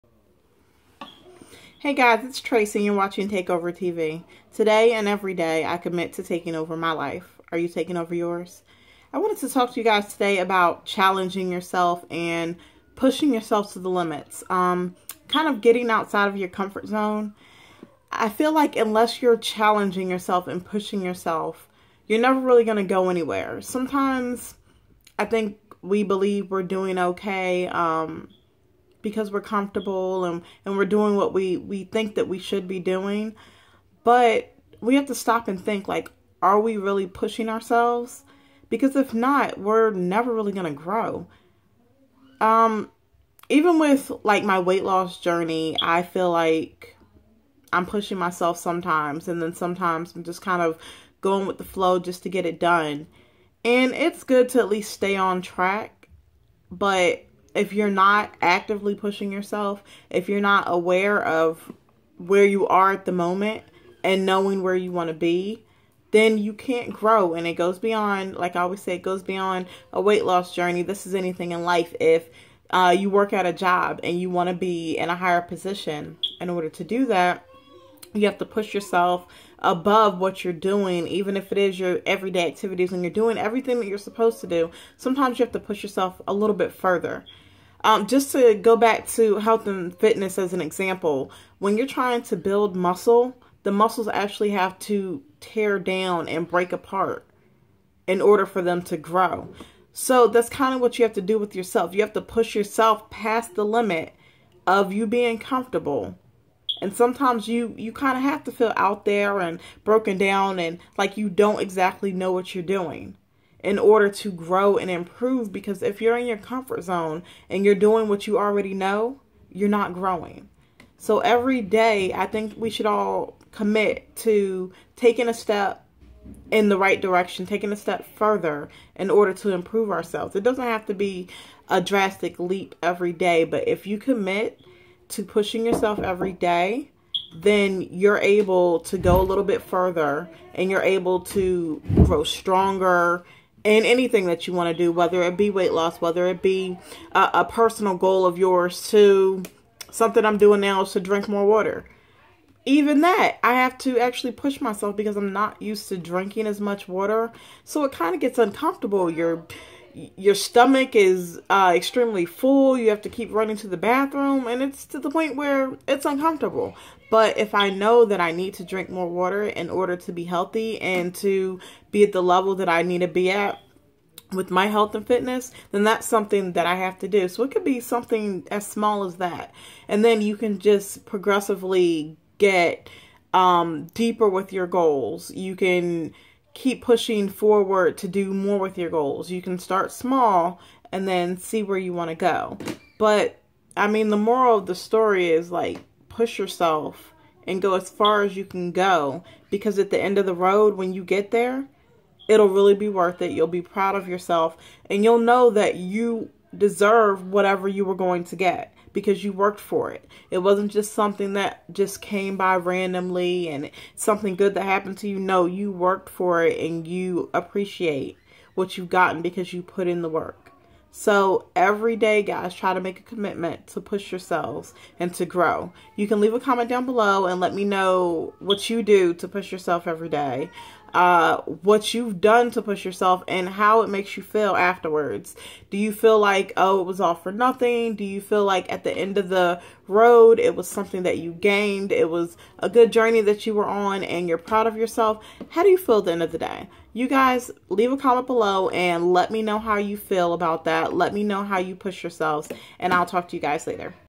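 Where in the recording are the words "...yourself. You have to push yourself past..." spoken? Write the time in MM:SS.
01:41.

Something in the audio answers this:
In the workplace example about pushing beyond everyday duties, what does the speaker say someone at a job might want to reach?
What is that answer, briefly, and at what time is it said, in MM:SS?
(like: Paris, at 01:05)
higher position, at 01:15.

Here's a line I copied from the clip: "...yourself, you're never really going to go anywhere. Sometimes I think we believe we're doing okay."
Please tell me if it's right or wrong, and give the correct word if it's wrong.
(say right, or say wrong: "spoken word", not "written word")
right.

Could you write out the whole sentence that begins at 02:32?
Even that, I have to actually push myself because I'm not used to drinking as much water.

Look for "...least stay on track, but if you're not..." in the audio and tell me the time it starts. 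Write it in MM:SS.
00:54.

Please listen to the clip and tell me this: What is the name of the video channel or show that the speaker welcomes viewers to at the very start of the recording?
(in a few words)
Takeover TV.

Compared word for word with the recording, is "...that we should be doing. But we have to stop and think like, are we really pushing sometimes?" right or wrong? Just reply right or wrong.
wrong.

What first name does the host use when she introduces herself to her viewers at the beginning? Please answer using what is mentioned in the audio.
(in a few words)
Tracie.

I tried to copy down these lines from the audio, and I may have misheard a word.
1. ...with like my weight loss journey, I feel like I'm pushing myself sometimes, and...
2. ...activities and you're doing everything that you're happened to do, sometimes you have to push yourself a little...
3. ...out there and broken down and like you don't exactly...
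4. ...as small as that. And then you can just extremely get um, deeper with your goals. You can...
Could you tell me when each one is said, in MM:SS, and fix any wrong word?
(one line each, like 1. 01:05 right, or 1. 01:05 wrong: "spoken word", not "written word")
1. 00:43 right
2. 01:22 wrong: "supposed", not "happened"
3. 01:48 right
4. 02:58 wrong: "progressively", not "extremely".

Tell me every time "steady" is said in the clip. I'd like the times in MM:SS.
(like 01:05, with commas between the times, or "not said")
not said.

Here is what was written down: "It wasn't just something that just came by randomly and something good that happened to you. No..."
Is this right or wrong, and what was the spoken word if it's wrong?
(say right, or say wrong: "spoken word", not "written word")
right.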